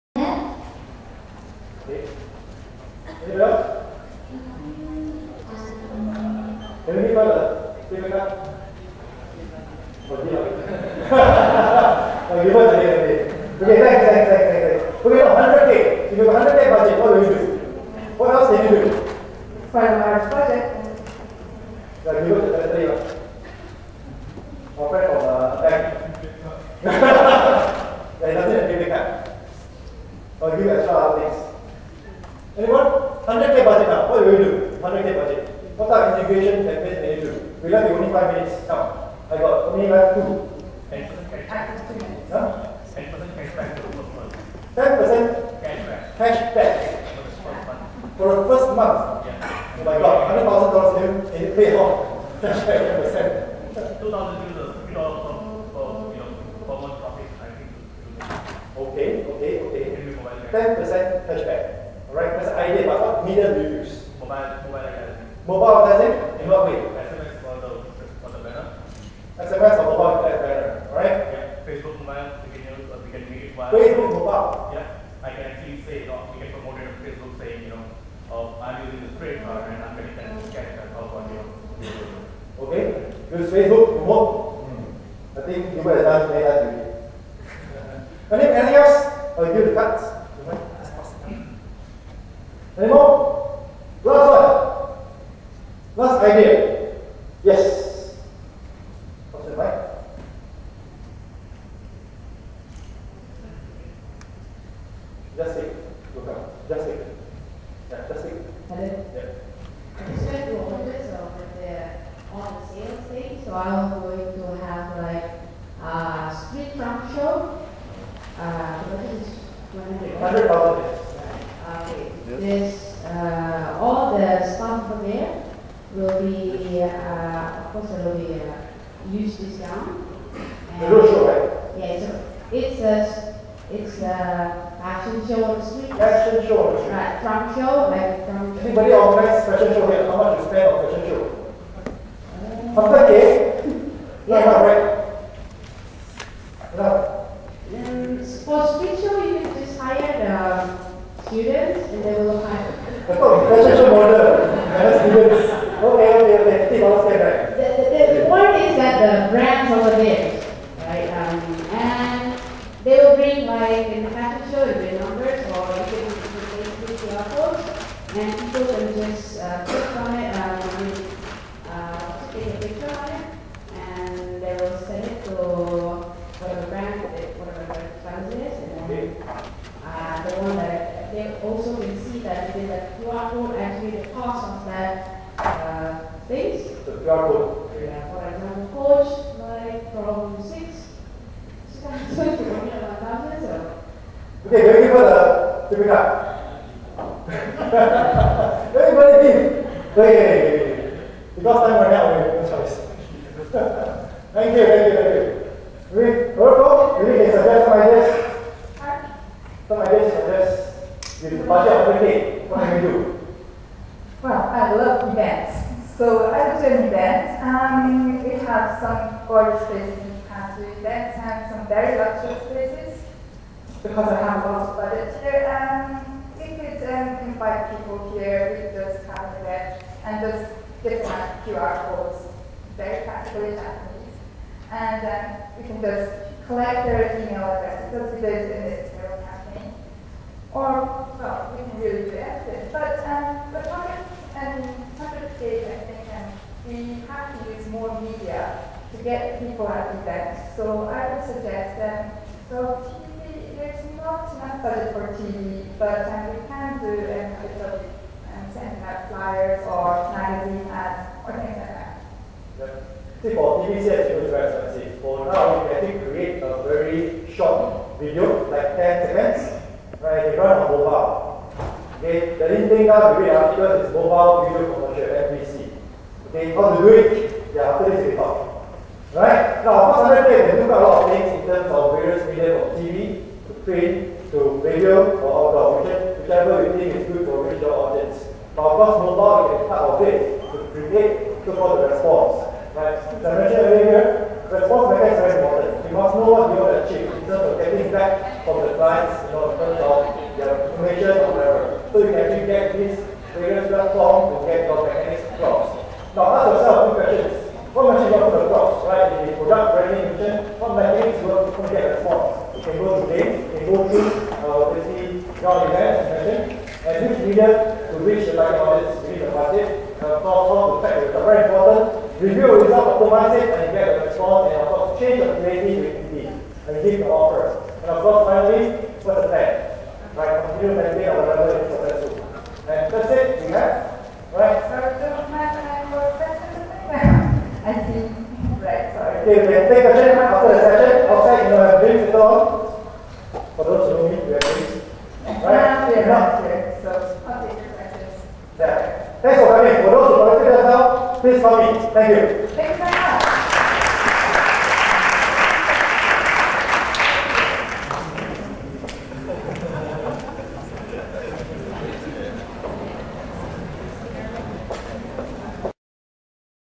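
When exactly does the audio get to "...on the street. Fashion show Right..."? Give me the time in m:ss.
2:15.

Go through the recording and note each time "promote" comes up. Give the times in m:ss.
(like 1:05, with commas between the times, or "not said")
1:16, 1:23.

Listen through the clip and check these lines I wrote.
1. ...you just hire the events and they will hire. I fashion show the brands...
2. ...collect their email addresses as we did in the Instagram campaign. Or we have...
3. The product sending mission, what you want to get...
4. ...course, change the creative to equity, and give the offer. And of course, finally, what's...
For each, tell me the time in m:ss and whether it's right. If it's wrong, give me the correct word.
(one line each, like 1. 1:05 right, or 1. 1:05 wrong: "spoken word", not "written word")
1. 2:29 wrong: "students", not "events"
2. 3:56 right
3. 5:09 wrong: "branding", not "sending"
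4. 5:24 right.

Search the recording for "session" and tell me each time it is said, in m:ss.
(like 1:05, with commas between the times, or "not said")
5:16, 5:40.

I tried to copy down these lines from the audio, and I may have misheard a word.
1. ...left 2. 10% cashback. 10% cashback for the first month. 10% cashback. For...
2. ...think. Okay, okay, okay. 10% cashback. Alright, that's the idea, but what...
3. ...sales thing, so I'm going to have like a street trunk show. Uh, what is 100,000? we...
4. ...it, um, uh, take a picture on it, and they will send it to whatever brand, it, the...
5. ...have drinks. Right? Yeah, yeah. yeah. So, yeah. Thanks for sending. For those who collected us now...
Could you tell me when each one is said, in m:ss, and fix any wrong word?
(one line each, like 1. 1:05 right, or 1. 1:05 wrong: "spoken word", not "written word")
1. 0:39 right
2. 0:57 right
3. 1:52 right
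4. 2:50 right
5. 5:44 wrong: "coming", not "sending".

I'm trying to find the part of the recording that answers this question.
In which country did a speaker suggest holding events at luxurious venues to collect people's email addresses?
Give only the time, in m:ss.
3:40.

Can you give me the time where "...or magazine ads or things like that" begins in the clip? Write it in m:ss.
4:19.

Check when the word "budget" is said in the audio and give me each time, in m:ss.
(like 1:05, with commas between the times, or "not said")
0:35, 3:44, 4:14.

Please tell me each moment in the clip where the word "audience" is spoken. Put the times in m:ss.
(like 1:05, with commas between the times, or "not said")
4:47, 5:18.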